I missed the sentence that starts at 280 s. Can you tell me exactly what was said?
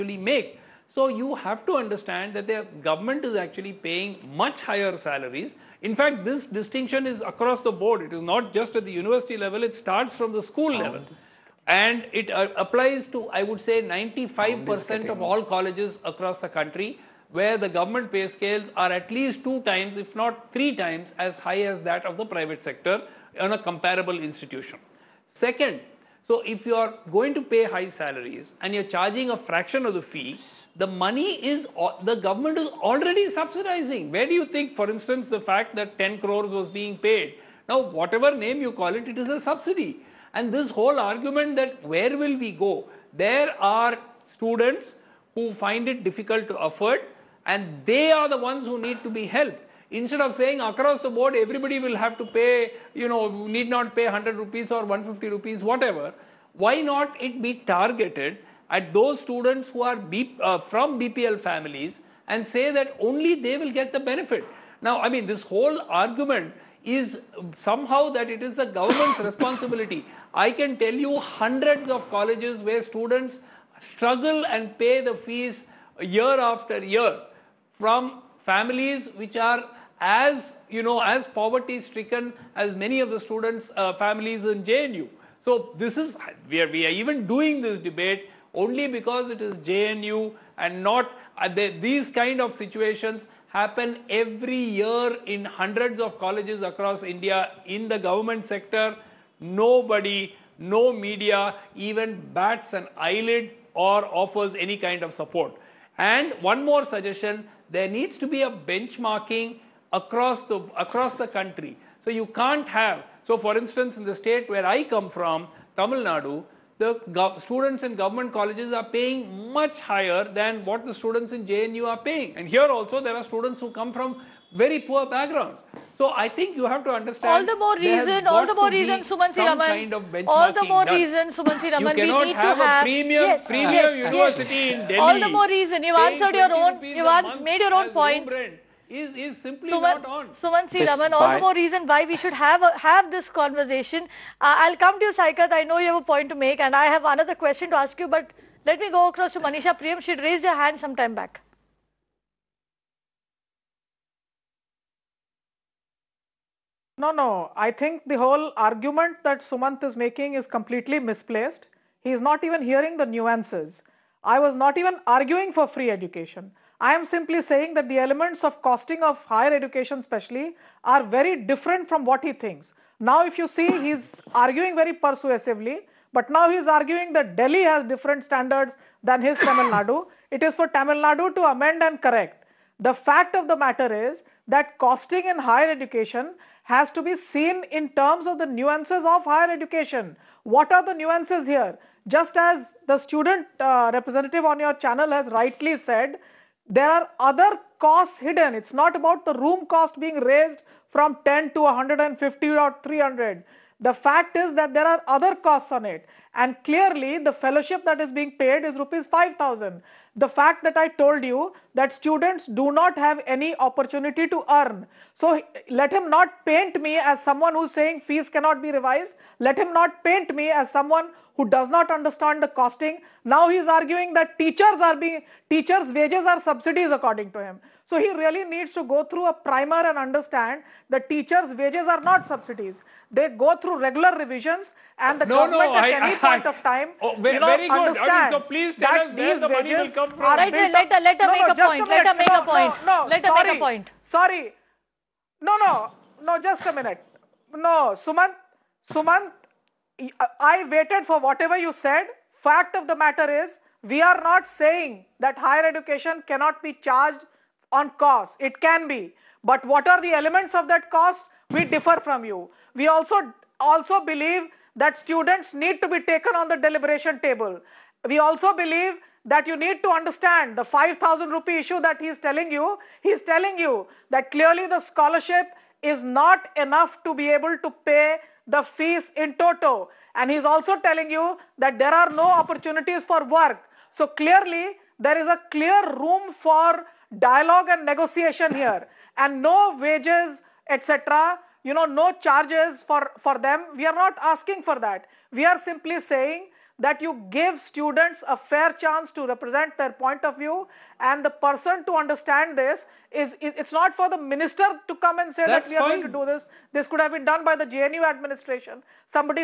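And he is also telling you that there are no opportunities for work.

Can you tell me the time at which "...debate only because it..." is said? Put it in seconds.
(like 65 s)
87 s.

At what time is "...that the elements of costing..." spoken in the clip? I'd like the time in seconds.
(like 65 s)
167 s.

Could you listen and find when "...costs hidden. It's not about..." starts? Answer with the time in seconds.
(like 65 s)
197 s.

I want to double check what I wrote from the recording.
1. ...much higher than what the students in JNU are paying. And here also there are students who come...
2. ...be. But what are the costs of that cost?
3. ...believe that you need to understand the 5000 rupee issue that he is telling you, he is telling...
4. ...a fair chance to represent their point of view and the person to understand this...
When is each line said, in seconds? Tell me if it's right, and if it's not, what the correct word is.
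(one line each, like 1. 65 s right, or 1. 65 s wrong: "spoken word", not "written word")
1. 119 s right
2. 258 s wrong: "elements", not "costs"
3. 268 s right
4. 298 s right.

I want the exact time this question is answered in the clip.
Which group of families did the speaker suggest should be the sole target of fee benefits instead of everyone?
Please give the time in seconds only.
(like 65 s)
60 s.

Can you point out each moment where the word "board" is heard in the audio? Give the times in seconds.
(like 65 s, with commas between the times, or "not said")
7 s, 51 s.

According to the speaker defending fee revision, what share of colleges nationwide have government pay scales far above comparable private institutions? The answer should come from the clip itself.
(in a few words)
95%.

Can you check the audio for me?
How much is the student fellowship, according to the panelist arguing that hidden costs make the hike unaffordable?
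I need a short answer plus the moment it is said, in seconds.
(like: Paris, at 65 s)
5,000 rupees, at 208 s.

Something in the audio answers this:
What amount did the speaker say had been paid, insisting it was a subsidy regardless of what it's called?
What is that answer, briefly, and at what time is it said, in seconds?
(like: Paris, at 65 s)
10 crores, at 35 s.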